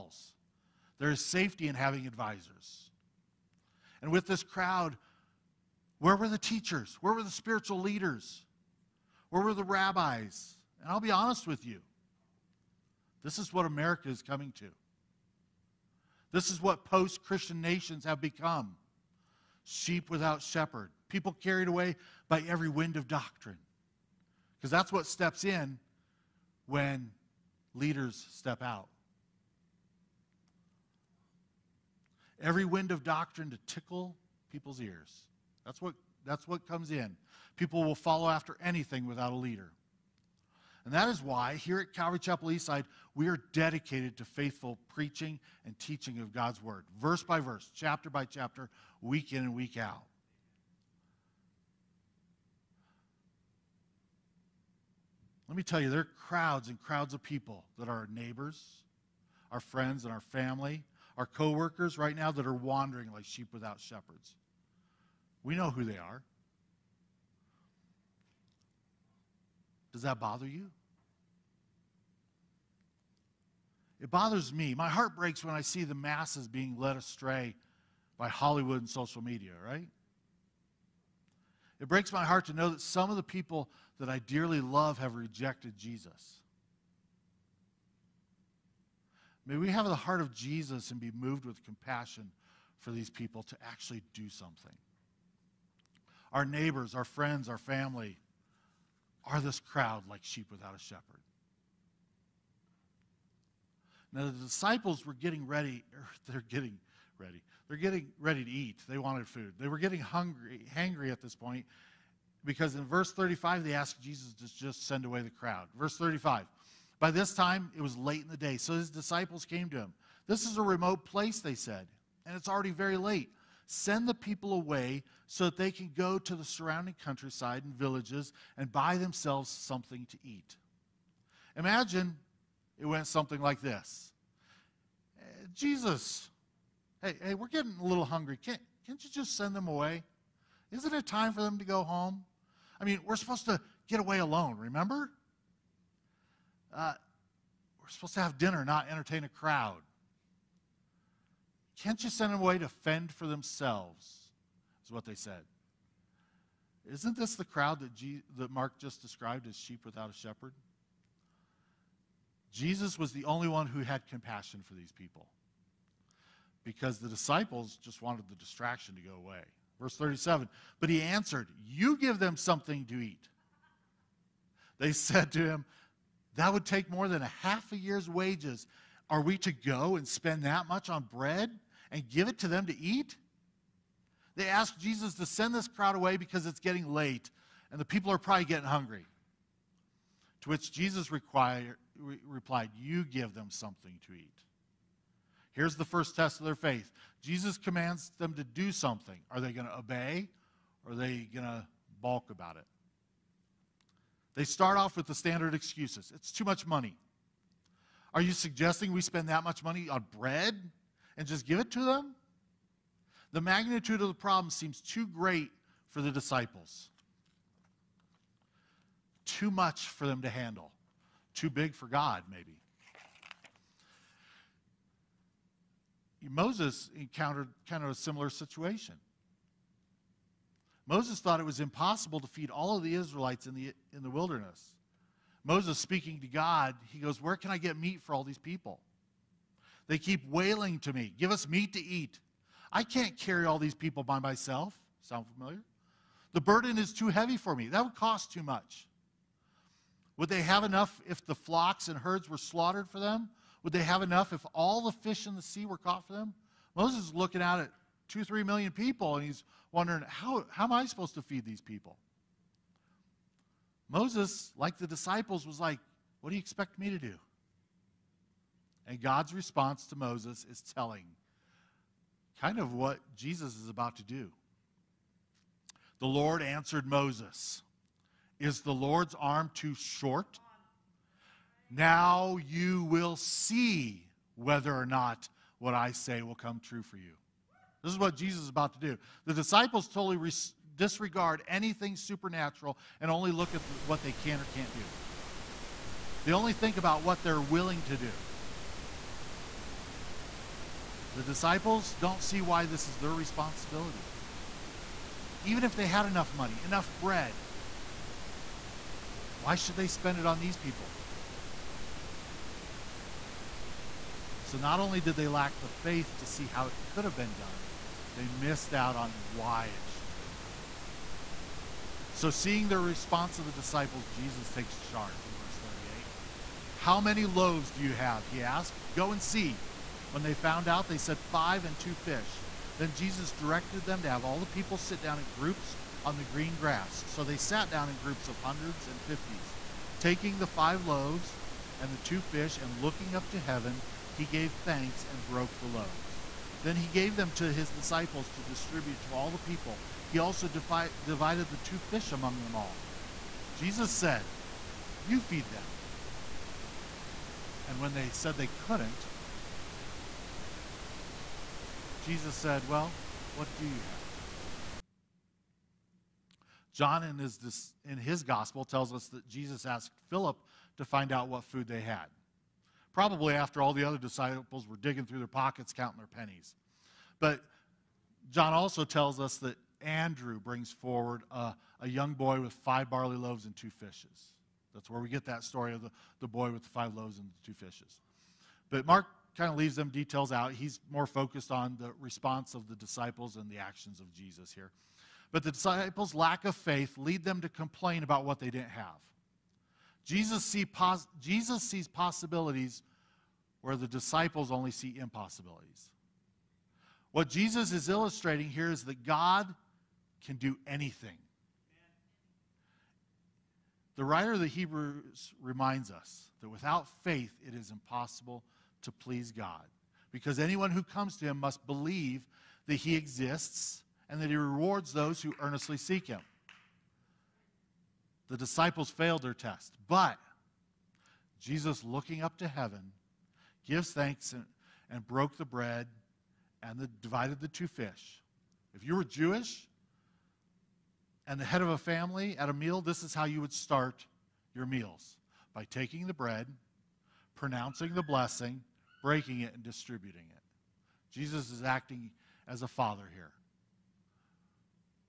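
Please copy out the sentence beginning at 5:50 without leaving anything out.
He also defi- divided the two fish among them all.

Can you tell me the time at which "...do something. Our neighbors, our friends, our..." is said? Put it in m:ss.
1:34.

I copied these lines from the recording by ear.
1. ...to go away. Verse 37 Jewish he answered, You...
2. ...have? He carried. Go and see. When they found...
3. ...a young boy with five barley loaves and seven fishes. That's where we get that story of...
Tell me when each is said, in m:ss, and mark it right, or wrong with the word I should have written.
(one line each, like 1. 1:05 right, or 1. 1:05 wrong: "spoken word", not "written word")
1. 2:48 wrong: "But", not "Jewish"
2. 5:27 wrong: "asked", not "carried"
3. 6:21 wrong: "two", not "seven".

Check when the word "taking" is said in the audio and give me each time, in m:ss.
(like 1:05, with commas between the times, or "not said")
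5:40, 7:25.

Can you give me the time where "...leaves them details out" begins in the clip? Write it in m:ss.
6:29.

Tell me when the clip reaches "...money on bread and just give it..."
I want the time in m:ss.
3:29.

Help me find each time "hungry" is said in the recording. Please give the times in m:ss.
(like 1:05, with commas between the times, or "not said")
1:50, 2:18, 3:08.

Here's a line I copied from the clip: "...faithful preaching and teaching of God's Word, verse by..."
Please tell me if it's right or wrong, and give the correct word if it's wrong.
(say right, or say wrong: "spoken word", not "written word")
right.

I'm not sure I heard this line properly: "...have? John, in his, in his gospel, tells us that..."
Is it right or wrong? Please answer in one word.
right.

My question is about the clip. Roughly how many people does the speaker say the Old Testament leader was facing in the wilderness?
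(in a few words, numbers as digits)
2 to 3 million.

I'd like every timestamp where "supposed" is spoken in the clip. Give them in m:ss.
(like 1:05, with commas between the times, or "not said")
2:23, 2:27, 4:20.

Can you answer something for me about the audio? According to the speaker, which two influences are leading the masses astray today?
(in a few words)
Hollywood and social media.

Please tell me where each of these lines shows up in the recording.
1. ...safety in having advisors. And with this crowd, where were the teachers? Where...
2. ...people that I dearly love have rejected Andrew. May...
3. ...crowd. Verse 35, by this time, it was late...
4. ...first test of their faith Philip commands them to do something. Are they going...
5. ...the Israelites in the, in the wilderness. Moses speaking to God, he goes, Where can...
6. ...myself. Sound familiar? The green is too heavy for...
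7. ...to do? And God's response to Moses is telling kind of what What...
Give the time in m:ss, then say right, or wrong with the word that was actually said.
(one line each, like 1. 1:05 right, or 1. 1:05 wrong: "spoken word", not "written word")
1. 0:01 right
2. 1:23 wrong: "Jesus", not "Andrew"
3. 1:55 right
4. 3:15 wrong: "Jesus", not "Philip"
5. 3:52 right
6. 4:04 wrong: "burden", not "green"
7. 4:26 wrong: "Jesus", not "What".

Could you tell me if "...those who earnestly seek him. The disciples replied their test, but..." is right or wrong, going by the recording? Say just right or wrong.
wrong.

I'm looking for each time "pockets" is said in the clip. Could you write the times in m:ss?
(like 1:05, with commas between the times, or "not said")
6:15.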